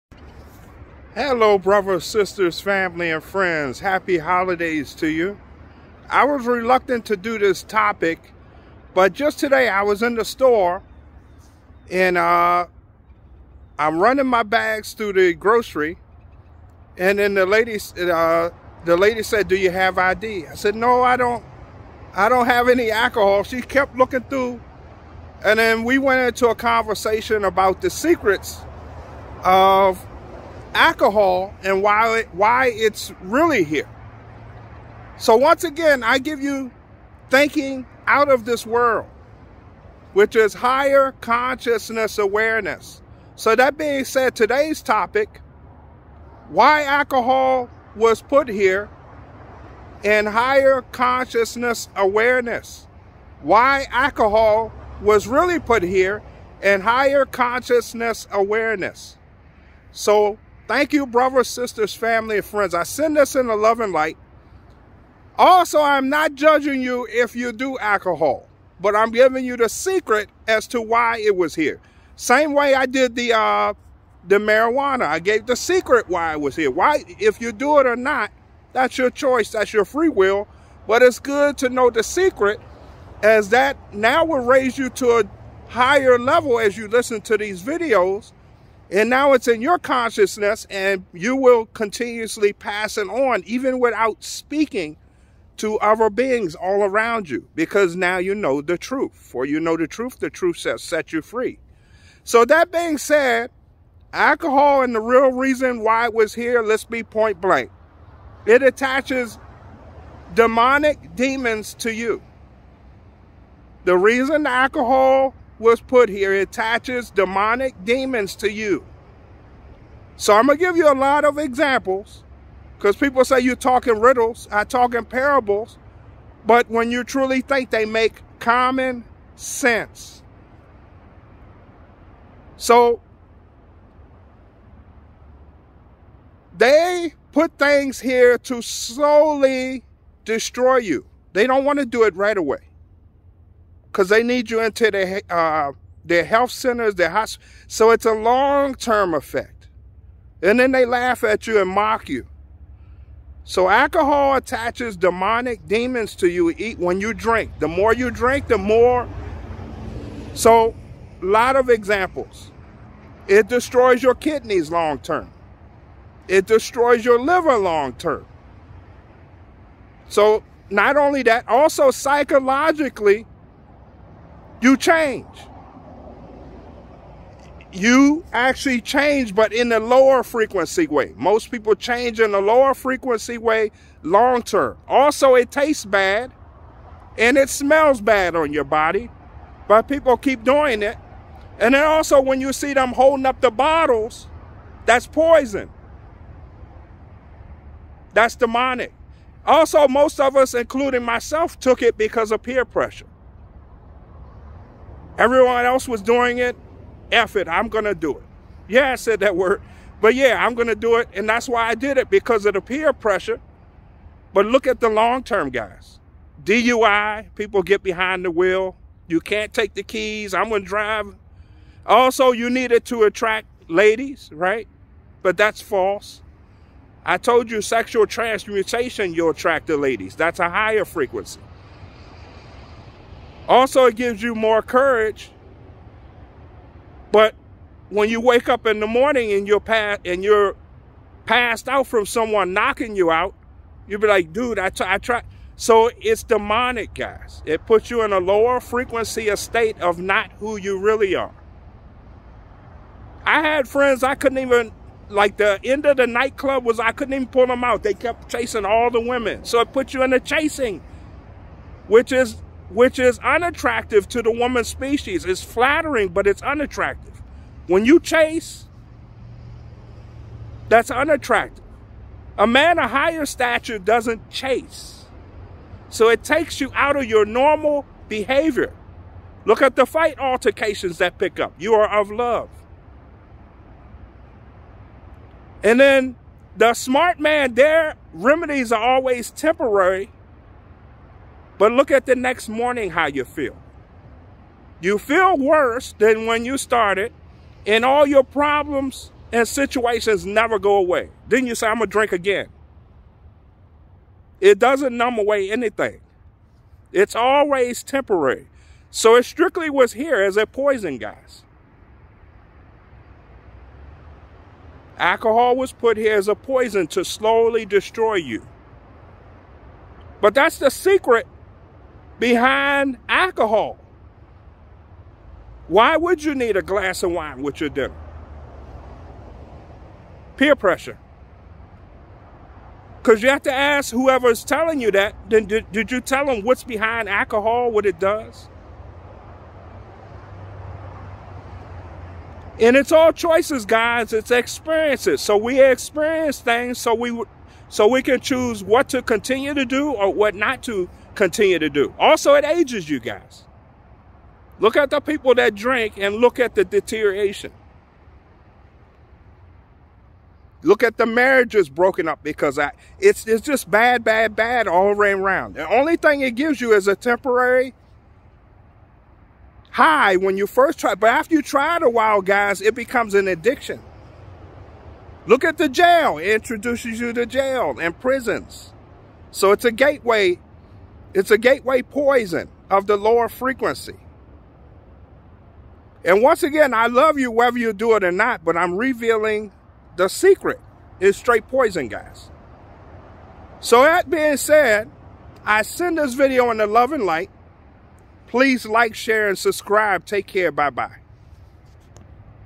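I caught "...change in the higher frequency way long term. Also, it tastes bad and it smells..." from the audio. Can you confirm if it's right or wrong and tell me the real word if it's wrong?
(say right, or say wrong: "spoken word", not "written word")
wrong: "lower", not "higher".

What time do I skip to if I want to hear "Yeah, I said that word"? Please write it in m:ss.
3:28.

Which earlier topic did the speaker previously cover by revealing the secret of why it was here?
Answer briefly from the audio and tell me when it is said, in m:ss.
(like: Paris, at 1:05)
marijuana, at 1:14.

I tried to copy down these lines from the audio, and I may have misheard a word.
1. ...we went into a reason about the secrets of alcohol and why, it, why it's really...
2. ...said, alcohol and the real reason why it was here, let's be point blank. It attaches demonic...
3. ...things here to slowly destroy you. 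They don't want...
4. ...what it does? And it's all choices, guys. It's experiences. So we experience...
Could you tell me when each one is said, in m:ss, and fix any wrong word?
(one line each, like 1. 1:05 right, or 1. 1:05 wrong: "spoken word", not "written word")
1. 0:25 wrong: "conversation", not "reason"
2. 1:42 right
3. 2:17 right
4. 5:37 right.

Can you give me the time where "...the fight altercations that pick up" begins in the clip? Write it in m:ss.
4:39.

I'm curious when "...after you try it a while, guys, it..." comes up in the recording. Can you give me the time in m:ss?
6:11.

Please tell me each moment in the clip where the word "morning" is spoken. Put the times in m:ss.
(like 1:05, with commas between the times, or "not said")
3:58, 4:52.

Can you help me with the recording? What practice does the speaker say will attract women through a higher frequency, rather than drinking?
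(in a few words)
sexual transmutation.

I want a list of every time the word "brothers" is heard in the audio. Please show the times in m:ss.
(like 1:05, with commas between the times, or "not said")
0:01, 1:01.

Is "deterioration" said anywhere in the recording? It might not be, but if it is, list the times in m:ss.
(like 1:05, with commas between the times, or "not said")
5:56.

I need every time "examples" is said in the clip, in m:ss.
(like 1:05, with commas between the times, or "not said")
2:01, 2:41.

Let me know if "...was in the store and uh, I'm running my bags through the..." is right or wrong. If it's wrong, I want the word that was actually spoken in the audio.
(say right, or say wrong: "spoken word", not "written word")
right.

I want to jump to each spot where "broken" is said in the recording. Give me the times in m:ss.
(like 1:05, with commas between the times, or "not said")
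6:01.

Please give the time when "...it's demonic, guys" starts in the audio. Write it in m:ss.
4:05.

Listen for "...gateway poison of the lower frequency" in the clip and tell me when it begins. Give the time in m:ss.
6:21.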